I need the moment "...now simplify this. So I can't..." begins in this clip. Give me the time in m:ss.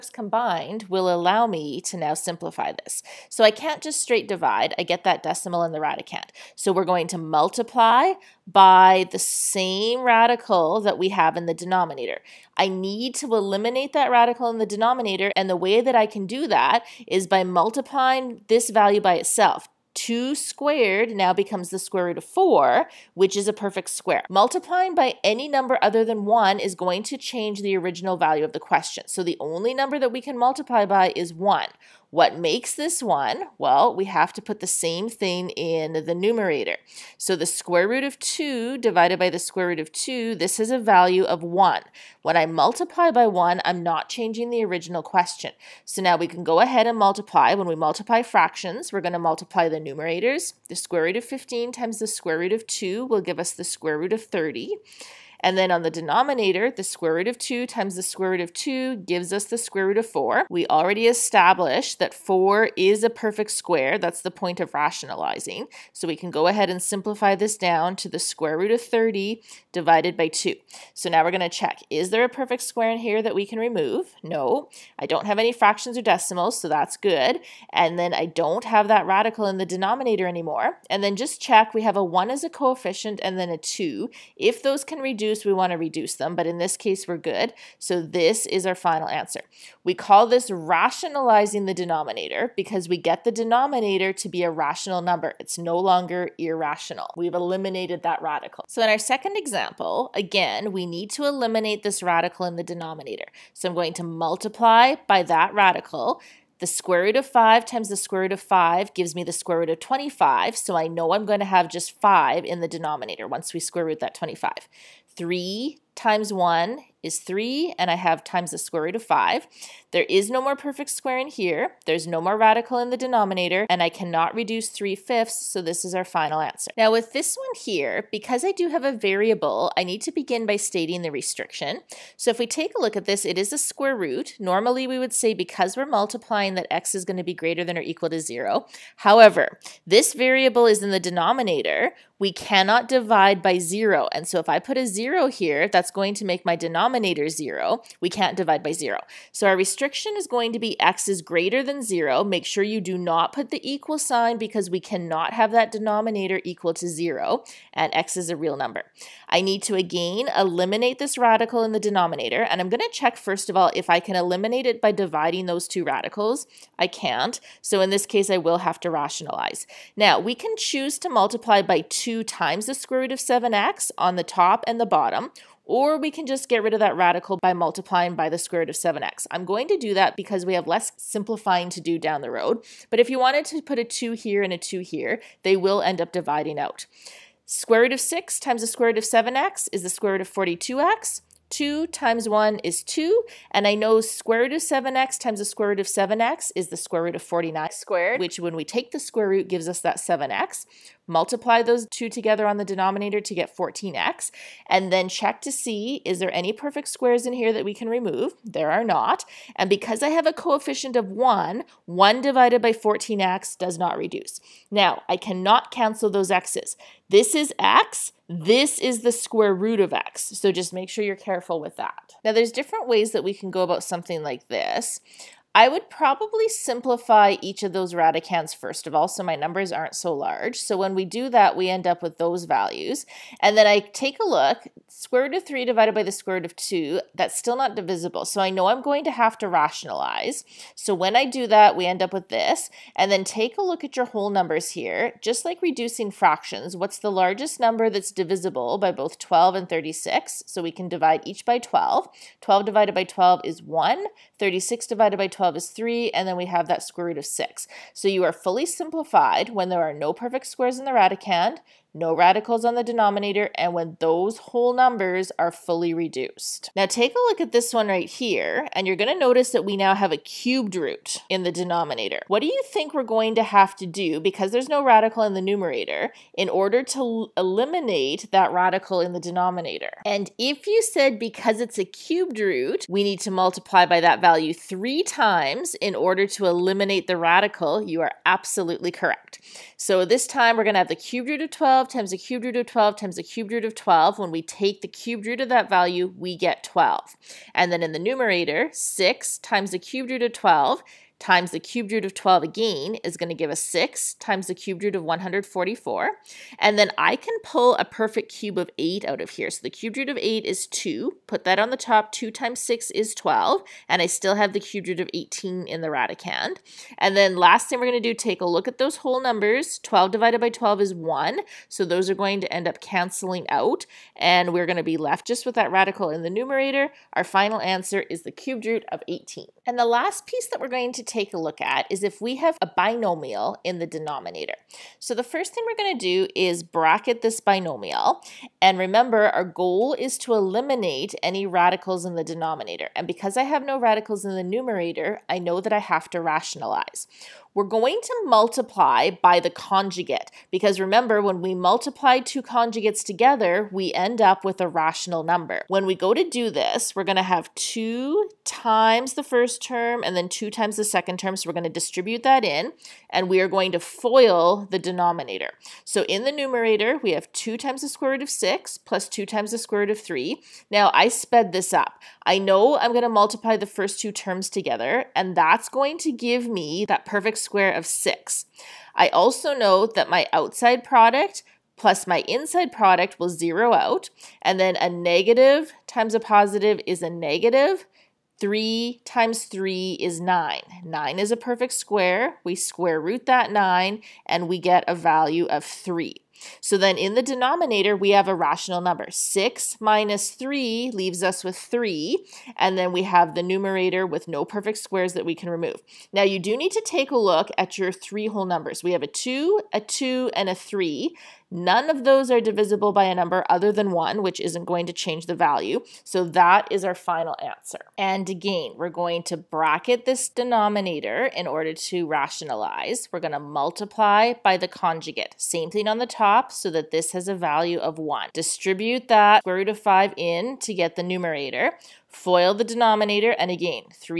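0:01.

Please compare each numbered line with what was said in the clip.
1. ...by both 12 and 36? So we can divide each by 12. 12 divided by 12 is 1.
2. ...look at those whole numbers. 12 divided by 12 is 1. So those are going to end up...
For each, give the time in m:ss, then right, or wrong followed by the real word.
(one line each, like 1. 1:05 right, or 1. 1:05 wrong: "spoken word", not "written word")
1. 4:08 right
2. 5:18 right.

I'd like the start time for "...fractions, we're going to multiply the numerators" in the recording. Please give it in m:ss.
0:48.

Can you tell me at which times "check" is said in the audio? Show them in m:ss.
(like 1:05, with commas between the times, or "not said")
1:11, 1:21, 2:42, 3:25.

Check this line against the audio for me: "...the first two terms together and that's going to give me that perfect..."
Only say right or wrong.
right.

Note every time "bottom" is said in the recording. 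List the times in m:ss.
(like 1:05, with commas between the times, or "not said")
2:54.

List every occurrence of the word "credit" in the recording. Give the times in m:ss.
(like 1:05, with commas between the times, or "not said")
not said.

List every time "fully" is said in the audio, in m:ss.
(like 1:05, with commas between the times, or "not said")
4:18, 4:25.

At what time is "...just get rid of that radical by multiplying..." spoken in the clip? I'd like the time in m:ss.
2:56.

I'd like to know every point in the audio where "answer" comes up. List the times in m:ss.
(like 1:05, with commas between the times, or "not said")
1:29, 2:06, 5:27, 6:57.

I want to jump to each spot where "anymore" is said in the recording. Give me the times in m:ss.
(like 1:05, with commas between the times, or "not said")
1:20.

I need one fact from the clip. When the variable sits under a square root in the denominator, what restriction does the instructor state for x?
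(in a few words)
x is greater than zero.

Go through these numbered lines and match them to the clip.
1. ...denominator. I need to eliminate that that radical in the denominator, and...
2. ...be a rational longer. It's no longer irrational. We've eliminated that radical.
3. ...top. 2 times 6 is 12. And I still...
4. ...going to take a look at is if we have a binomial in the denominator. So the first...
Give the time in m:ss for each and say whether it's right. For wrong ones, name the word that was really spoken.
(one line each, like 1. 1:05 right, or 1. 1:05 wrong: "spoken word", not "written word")
1. 0:11 right
2. 1:34 wrong: "number", not "longer"
3. 5:11 right
4. 5:30 right.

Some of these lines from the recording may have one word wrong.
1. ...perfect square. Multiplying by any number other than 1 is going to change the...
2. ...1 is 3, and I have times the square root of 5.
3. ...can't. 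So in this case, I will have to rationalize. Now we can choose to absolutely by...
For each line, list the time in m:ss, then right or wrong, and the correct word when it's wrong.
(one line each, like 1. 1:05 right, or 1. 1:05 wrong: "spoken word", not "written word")
1. 0:23 right
2. 1:56 right
3. 2:46 wrong: "multiply", not "absolutely".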